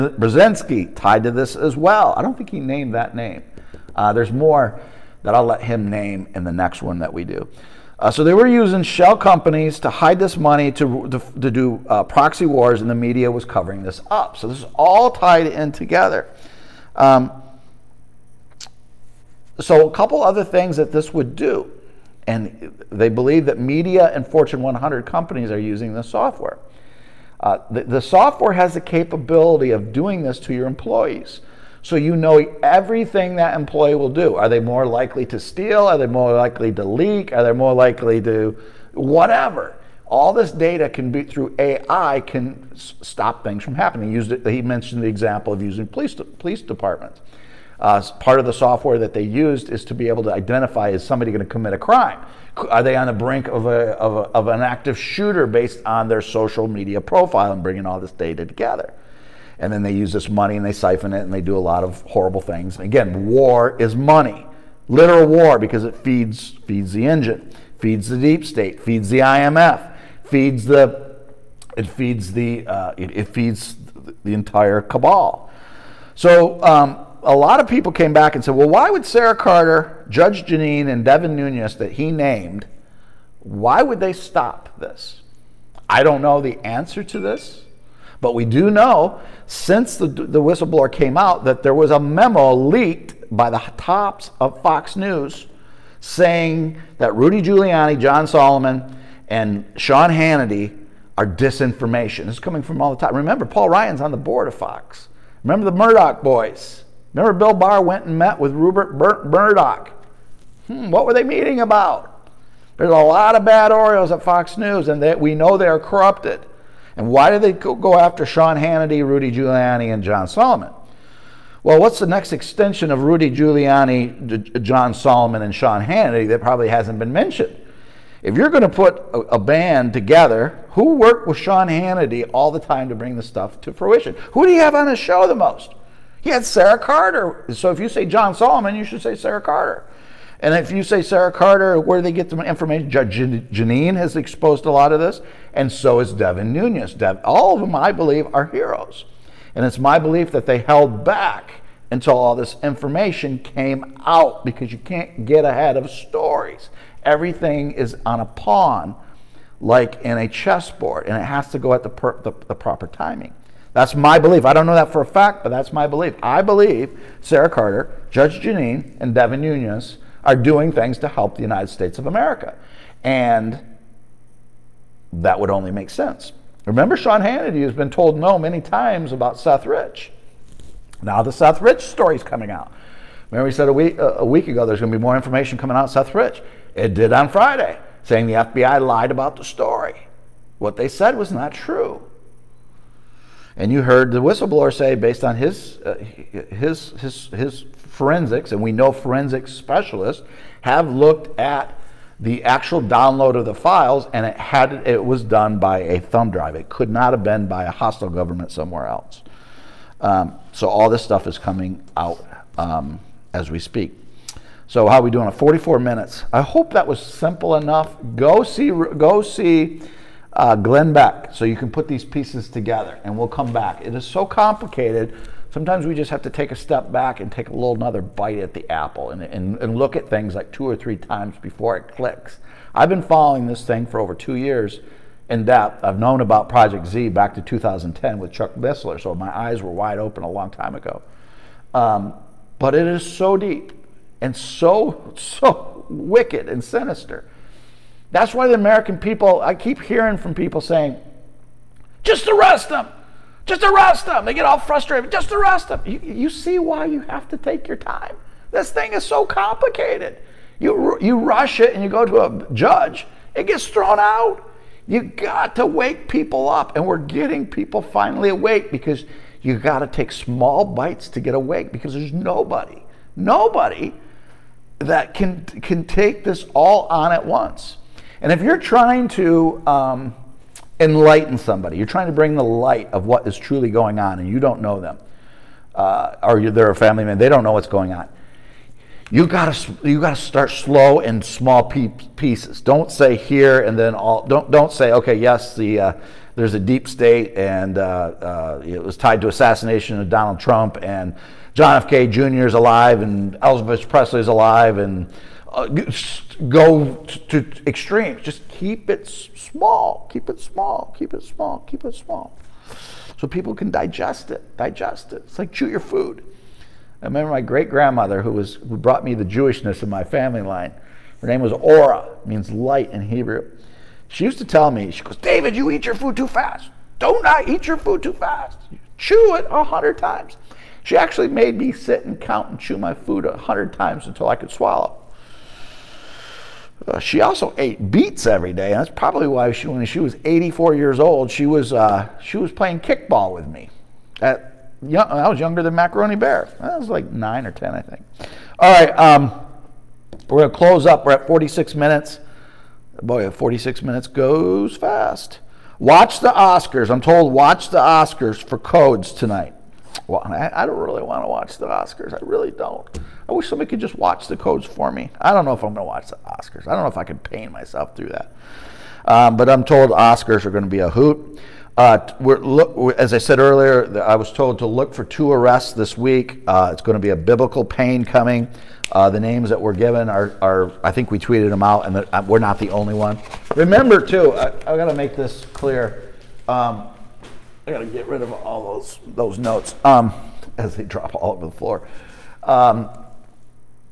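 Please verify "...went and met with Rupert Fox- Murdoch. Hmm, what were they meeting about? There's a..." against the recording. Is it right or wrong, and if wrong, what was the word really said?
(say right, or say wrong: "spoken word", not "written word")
wrong: "Bur", not "Fox".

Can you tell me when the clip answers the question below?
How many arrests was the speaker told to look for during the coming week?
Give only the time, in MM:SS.
06:15.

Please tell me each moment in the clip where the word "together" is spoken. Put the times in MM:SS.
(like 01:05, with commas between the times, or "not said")
00:15, 00:58, 02:09, 03:42.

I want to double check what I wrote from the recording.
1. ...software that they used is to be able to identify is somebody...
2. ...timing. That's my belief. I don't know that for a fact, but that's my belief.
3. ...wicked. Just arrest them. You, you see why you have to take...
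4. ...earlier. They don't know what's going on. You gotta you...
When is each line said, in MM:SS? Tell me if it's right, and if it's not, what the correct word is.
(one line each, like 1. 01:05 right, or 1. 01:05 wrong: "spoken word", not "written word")
1. 00:48 right
2. 02:42 right
3. 04:14 wrong: "frustrated", not "wicked"
4. 04:47 wrong: "member", not "earlier".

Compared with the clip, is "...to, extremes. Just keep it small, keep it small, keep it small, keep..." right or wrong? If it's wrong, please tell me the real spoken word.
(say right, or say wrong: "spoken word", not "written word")
right.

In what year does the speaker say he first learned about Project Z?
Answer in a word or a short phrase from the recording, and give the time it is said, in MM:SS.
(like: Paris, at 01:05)
2010, at 03:57.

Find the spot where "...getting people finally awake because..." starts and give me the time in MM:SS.
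04:26.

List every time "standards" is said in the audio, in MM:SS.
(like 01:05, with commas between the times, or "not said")
not said.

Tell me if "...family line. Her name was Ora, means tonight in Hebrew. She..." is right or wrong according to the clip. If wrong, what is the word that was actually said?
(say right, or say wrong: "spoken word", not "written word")
wrong: "light", not "tonight".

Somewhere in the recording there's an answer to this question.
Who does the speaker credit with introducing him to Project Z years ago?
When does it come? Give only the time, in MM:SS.
03:58.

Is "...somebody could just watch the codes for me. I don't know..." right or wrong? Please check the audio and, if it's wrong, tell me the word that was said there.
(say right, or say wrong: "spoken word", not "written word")
right.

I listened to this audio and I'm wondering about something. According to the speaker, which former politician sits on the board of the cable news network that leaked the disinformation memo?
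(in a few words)
Paul Ryan.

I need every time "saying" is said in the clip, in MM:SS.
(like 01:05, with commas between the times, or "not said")
01:36, 03:08, 04:10.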